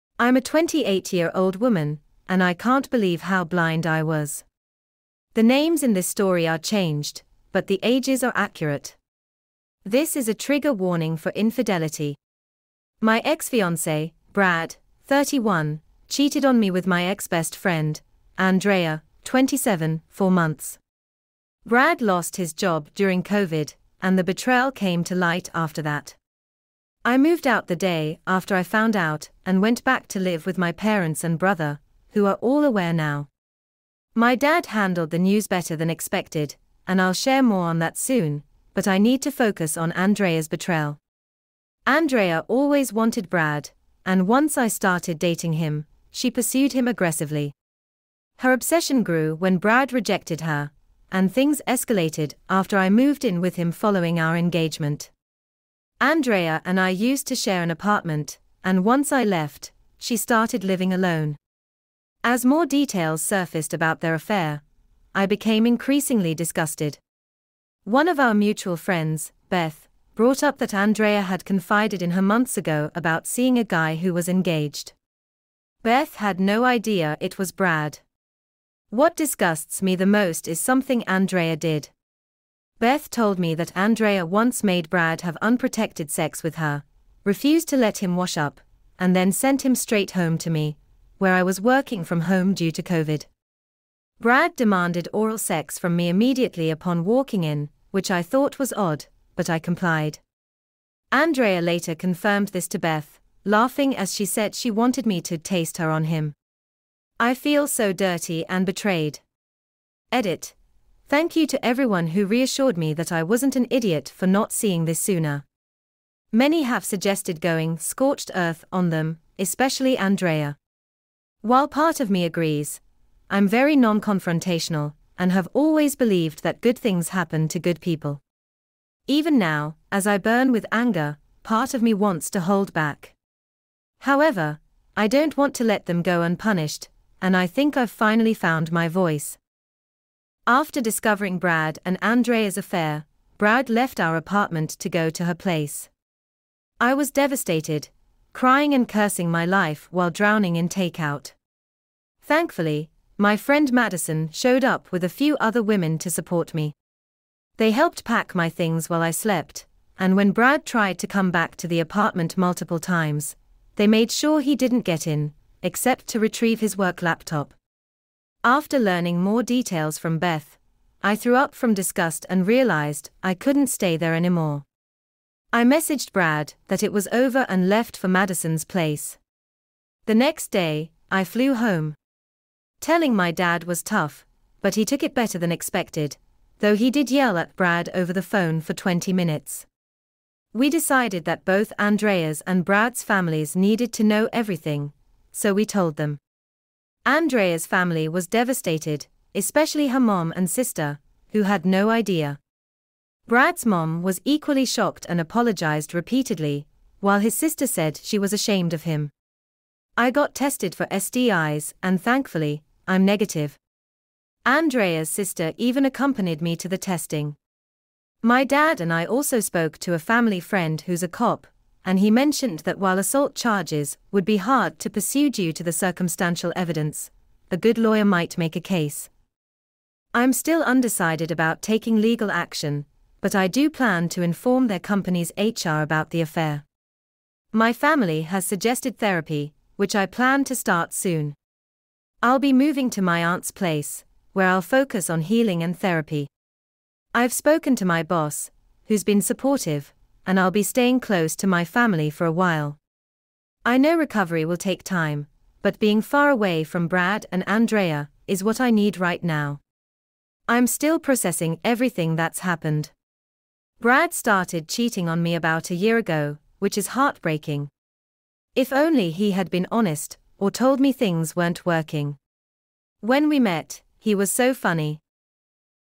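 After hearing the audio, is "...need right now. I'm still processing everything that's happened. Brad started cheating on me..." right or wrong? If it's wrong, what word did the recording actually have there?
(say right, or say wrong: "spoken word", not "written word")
right.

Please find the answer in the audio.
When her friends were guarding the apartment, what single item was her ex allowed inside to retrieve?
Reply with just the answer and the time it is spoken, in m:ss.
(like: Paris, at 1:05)
work laptop, at 2:46.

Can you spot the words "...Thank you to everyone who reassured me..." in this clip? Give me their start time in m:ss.
1:51.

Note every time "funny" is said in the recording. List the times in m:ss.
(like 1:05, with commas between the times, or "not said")
4:34.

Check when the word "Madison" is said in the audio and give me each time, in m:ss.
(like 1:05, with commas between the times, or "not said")
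2:33, 2:58.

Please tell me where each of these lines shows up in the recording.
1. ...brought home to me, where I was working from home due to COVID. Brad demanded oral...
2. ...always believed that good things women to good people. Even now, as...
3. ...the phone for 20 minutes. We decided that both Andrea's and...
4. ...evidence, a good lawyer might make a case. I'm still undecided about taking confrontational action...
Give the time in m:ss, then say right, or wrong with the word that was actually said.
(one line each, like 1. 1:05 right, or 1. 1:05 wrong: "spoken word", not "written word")
1. 1:29 wrong: "straight", not "brought"
2. 2:05 wrong: "happen", not "women"
3. 3:08 right
4. 3:46 wrong: "legal", not "confrontational".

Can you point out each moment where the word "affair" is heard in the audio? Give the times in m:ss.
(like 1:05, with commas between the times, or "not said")
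1:04, 2:22, 3:56.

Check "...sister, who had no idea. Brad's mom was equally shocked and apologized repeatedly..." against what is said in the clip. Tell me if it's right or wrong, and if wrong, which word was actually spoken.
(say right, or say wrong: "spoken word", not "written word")
right.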